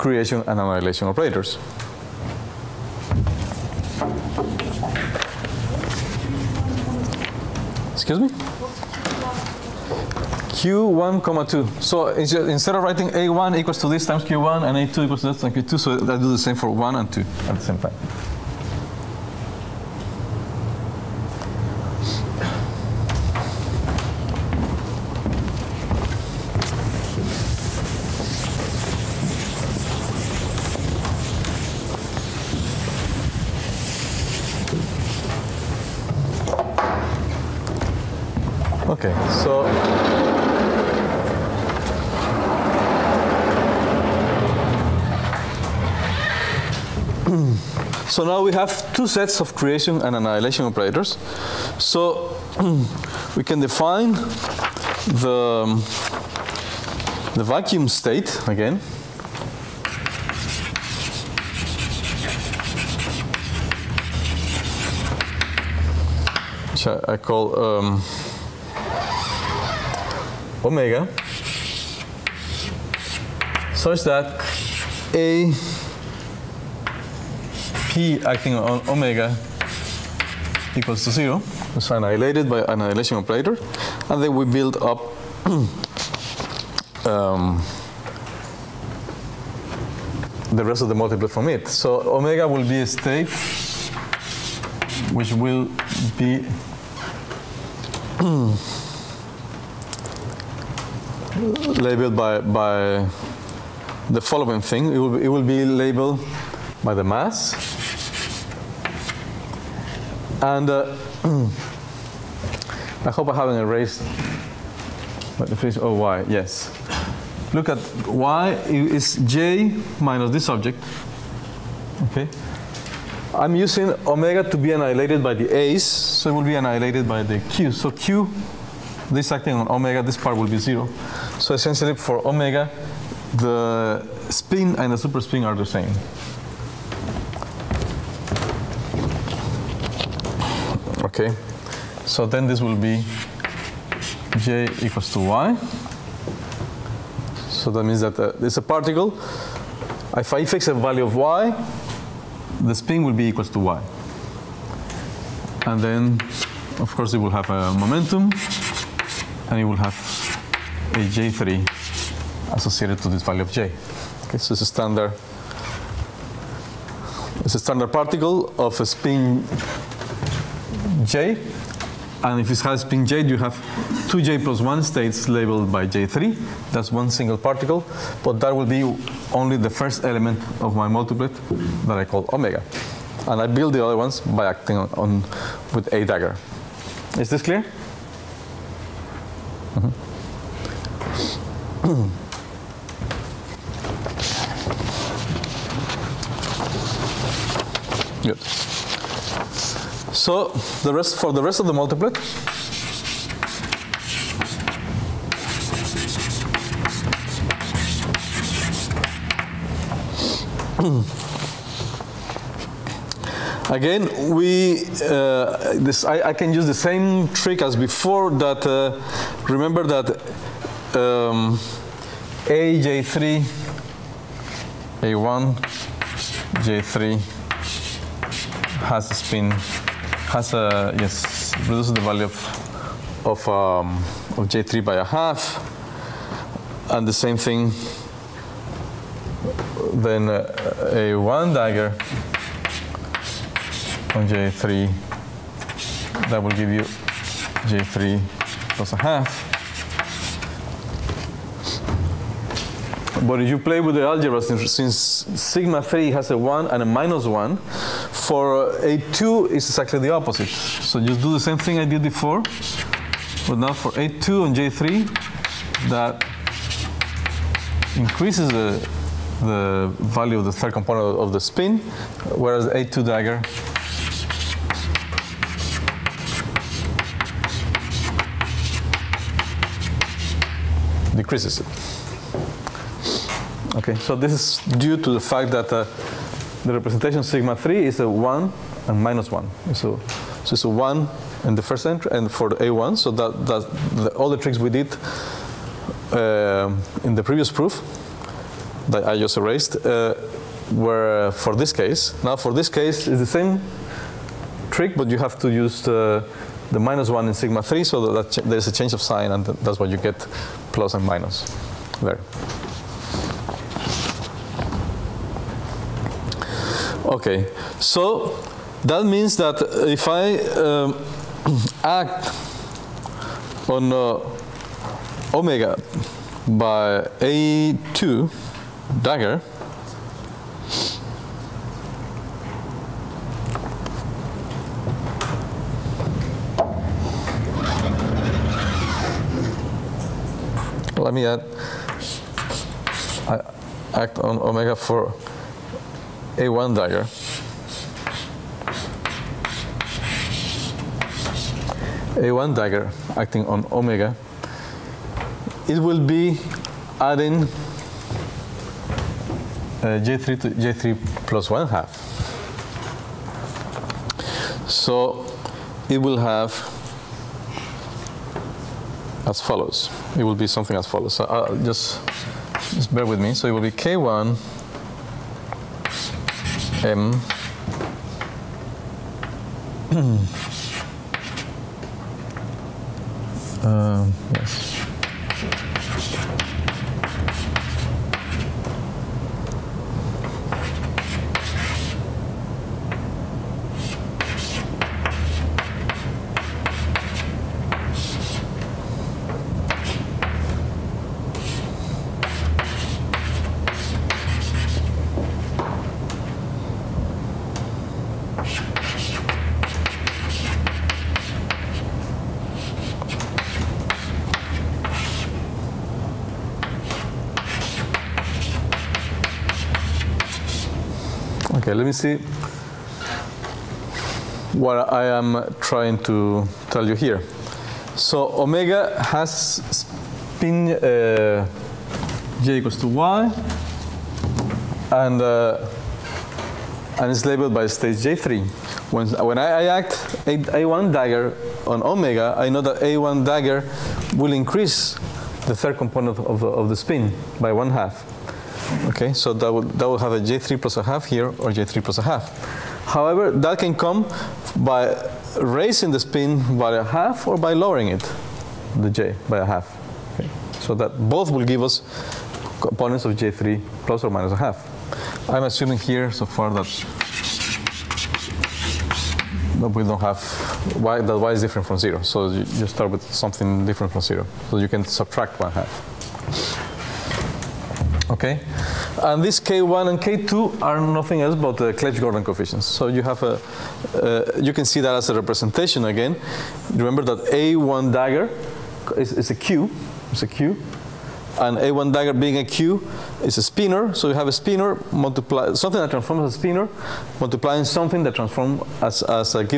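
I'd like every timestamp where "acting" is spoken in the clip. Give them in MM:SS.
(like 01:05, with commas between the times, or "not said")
01:18, 02:09, 03:04, 05:53.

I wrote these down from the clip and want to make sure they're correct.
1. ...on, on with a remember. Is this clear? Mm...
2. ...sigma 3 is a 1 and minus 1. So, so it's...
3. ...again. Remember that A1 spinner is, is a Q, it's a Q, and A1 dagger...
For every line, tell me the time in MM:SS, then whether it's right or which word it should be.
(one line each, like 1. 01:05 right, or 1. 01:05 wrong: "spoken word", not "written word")
1. 03:04 wrong: "dagger", not "remember"
2. 04:47 right
3. 08:05 wrong: "dagger", not "spinner".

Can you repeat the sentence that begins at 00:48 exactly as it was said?
So now we have two sets of creation and annihilation operators.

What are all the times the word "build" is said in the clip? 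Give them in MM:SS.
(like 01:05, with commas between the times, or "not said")
01:24, 03:03.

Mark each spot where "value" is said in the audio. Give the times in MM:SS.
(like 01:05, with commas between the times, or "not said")
02:30, 02:43, 03:52, 04:29.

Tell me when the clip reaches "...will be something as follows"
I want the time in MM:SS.
06:10.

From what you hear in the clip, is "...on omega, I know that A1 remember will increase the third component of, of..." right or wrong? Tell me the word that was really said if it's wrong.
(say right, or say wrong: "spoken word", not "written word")
wrong: "dagger", not "remember".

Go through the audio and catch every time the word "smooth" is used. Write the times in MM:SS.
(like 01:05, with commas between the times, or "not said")
not said.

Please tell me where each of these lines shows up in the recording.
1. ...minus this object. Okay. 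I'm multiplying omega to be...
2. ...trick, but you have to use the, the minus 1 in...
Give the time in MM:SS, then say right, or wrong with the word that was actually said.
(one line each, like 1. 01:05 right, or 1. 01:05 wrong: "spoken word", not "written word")
1. 01:59 wrong: "using", not "multiplying"
2. 05:04 right.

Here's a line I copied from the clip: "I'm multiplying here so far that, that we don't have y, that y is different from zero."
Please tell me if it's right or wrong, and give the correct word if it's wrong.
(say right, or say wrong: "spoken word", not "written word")
wrong: "assuming", not "multiplying".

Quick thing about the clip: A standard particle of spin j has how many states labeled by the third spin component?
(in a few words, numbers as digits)
2j plus 1.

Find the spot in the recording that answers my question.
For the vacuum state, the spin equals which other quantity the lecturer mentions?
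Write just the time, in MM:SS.
02:14.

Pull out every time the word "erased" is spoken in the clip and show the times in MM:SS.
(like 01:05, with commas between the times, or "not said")
01:53, 04:59.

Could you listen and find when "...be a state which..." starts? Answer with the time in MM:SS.
01:32.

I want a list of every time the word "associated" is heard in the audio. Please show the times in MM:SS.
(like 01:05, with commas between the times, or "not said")
02:42.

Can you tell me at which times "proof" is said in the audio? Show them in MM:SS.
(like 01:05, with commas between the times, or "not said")
04:57.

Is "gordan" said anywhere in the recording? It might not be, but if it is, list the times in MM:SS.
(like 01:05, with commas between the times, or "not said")
08:02.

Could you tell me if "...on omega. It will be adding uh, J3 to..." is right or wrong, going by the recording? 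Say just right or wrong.
right.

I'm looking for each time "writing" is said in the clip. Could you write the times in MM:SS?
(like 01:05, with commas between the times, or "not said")
00:12.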